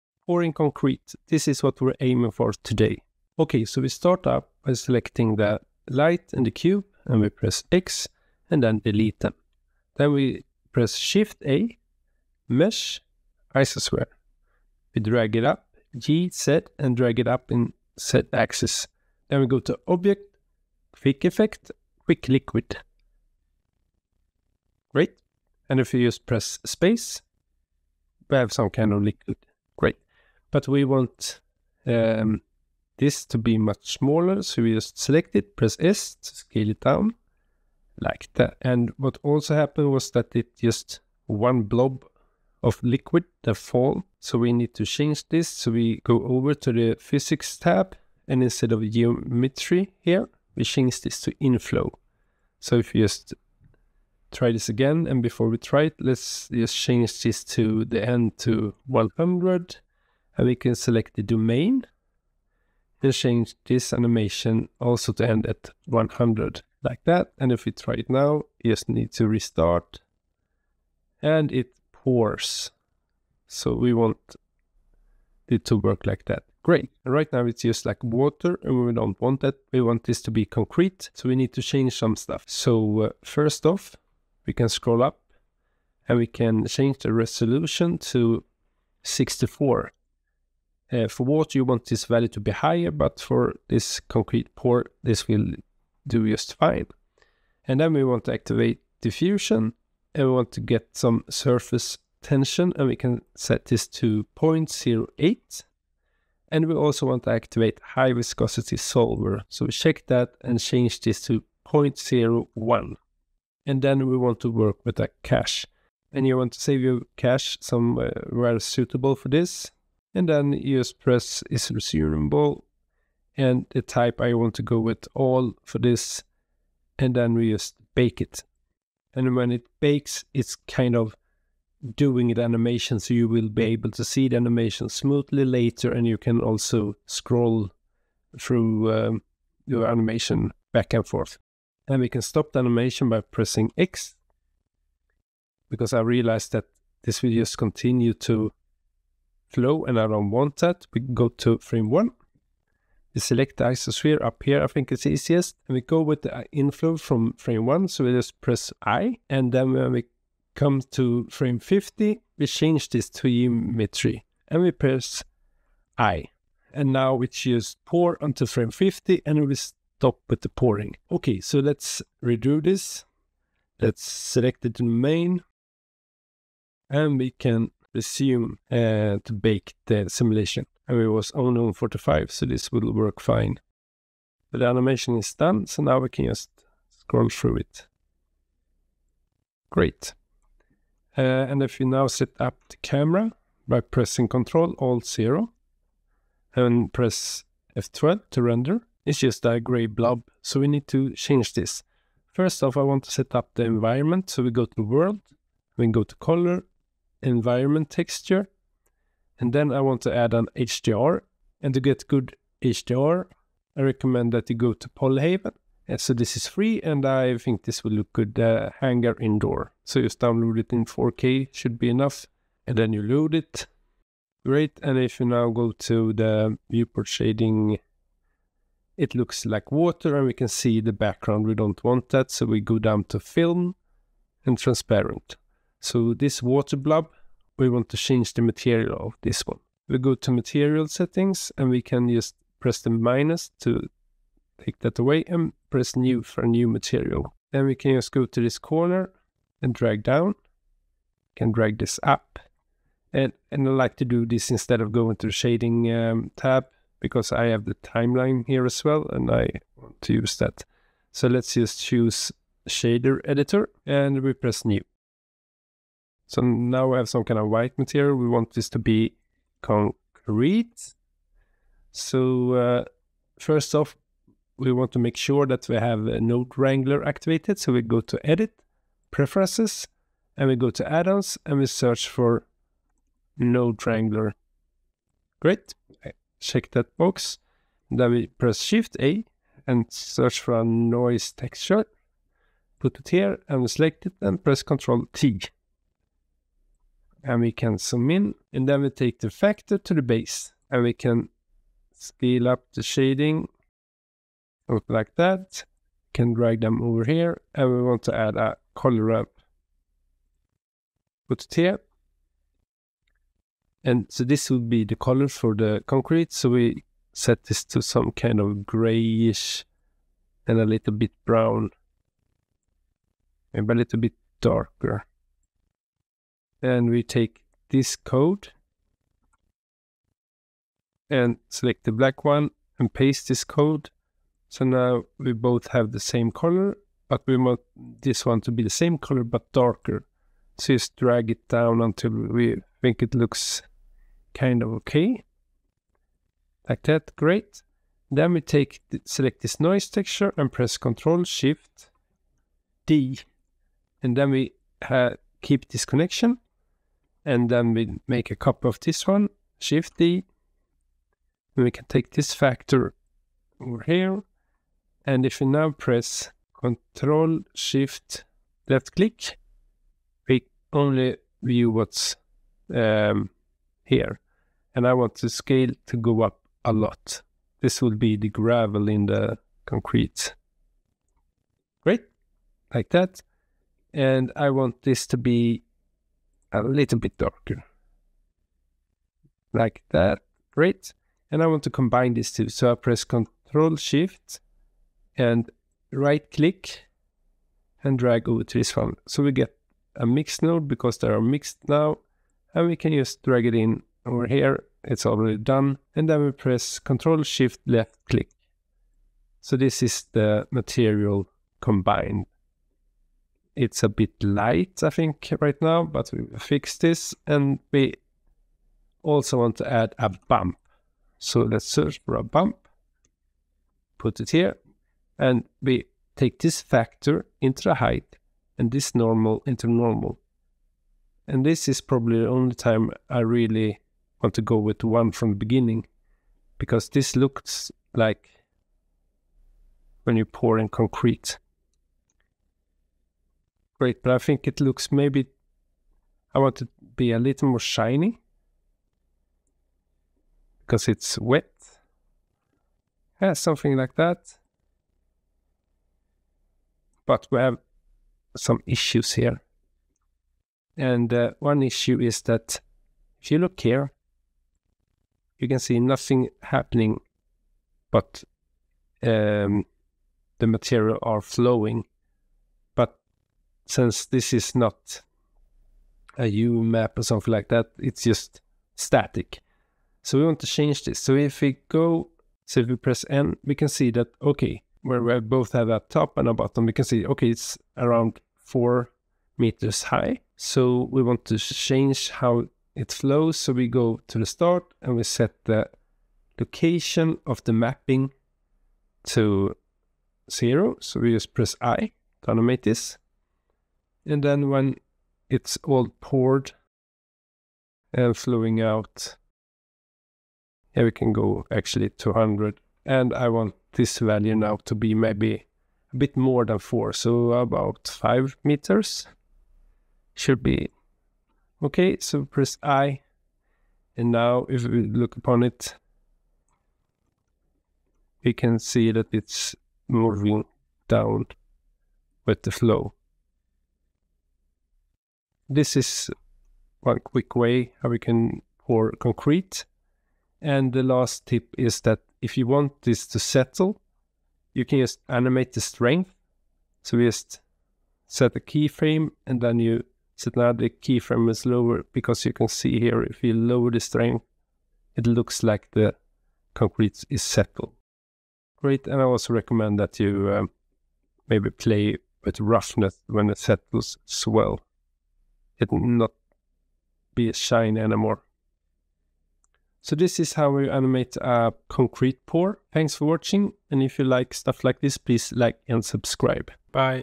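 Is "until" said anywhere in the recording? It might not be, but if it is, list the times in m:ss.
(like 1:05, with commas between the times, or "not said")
2:48, 5:41.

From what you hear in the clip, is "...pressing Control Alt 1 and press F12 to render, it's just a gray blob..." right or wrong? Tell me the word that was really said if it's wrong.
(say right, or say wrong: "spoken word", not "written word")
wrong: "0", not "1".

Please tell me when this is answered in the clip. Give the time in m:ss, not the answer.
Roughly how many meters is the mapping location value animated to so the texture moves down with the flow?
8:37.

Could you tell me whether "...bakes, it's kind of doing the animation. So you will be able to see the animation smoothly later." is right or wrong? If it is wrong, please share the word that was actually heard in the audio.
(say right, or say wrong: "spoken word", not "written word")
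right.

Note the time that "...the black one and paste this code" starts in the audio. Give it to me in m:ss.
5:31.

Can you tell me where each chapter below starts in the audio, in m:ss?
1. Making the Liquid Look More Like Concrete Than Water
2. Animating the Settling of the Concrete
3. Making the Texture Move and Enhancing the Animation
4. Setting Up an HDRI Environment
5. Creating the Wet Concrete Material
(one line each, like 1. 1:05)
1. 1:18
2. 9:04
3. 7:40
4. 3:24
5. 4:00.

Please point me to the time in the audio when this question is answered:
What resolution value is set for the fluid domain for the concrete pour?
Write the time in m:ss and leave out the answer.
1:29.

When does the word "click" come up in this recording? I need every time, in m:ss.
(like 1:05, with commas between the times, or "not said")
6:08, 6:36, 6:48.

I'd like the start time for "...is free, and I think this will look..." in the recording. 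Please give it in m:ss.
3:36.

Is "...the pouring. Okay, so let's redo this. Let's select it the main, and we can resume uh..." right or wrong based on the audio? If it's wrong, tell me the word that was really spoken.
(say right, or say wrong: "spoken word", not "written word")
right.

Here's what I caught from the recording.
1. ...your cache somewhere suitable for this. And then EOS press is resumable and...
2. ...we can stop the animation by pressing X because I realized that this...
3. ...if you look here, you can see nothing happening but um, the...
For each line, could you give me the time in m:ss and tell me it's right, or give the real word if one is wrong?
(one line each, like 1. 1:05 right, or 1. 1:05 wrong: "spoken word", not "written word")
1. 1:56 right
2. 2:22 right
3. 7:43 right.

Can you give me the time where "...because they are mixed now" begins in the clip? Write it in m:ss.
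6:40.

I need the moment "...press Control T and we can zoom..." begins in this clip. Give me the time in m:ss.
4:54.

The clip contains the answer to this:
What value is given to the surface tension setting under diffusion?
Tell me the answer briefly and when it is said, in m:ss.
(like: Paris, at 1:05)
0.08, at 1:44.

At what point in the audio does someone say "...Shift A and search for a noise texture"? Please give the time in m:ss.
4:48.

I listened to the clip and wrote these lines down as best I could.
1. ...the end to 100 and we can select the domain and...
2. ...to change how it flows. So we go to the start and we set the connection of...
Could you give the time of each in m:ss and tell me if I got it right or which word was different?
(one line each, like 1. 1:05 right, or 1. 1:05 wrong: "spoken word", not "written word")
1. 0:57 right
2. 8:11 wrong: "location", not "connection".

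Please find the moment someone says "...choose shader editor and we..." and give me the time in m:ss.
4:21.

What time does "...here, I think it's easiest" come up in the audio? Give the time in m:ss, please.
2:34.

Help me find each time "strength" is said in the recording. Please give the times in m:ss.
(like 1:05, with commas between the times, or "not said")
9:05, 9:13.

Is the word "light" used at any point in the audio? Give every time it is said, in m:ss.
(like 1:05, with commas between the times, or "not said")
0:05, 6:54.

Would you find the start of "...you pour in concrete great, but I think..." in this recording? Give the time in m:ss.
7:20.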